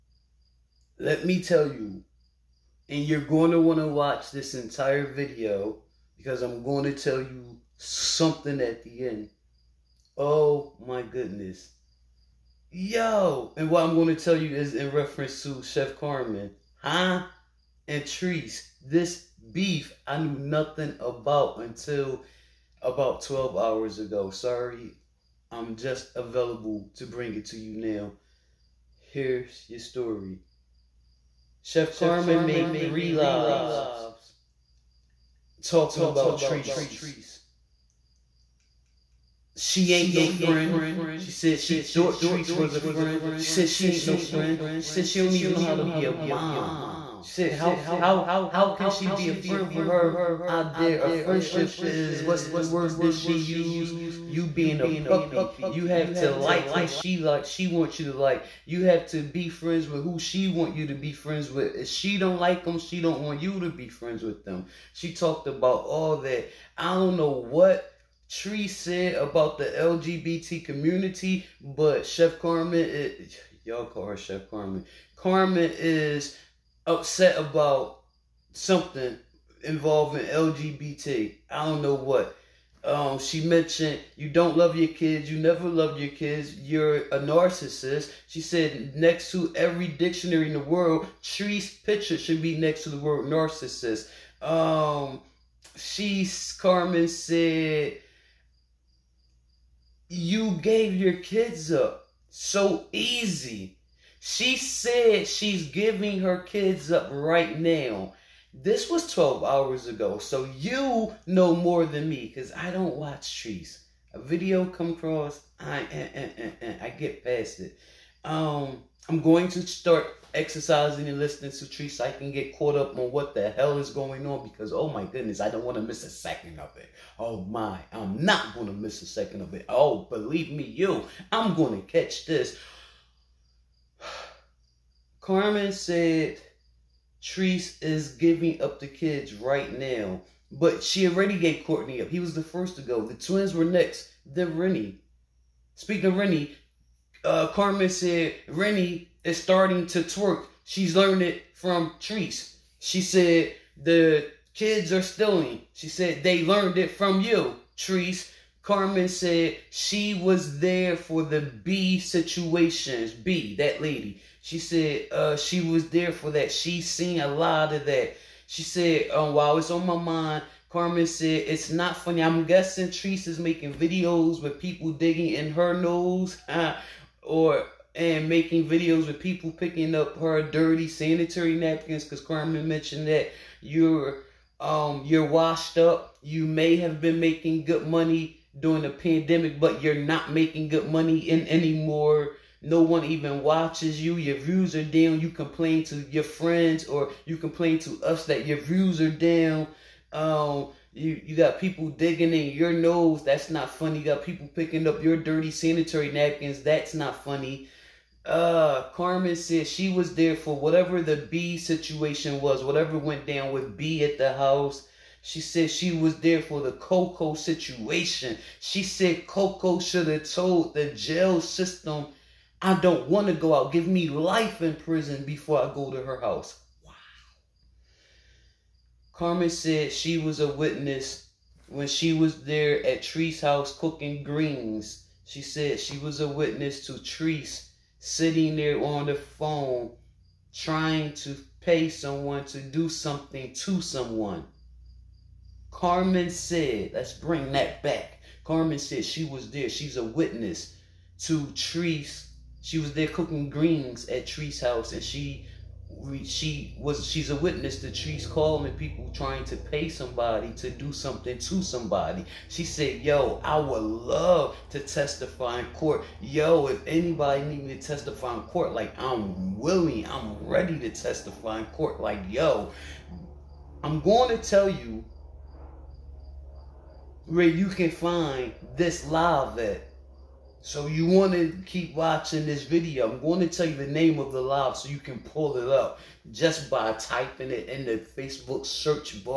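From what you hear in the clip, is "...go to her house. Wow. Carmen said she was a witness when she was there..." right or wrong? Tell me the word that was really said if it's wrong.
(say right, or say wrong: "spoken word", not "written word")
right.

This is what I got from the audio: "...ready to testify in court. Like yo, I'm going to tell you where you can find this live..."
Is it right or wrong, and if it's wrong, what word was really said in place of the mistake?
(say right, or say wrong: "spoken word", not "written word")
right.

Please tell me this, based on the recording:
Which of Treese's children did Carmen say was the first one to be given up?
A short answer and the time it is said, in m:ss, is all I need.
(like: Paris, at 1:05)
Courtney, at 2:21.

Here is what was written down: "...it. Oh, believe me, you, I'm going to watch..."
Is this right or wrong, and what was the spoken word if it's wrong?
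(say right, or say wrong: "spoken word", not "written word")
wrong: "catch", not "watch".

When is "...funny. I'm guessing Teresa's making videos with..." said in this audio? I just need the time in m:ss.
2:51.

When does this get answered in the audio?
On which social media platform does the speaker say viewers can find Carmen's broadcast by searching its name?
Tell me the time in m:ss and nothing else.
4:47.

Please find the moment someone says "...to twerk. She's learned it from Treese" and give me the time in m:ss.
2:29.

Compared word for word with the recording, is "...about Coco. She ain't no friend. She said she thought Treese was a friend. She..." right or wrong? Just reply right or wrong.
wrong.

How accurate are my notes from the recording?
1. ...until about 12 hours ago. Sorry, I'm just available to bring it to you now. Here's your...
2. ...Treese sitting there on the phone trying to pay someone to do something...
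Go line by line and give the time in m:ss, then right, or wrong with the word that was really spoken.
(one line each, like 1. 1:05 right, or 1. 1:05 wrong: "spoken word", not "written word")
1. 0:21 right
2. 3:56 right.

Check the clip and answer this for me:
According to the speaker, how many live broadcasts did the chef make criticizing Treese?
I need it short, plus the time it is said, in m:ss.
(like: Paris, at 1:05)
3, at 0:32.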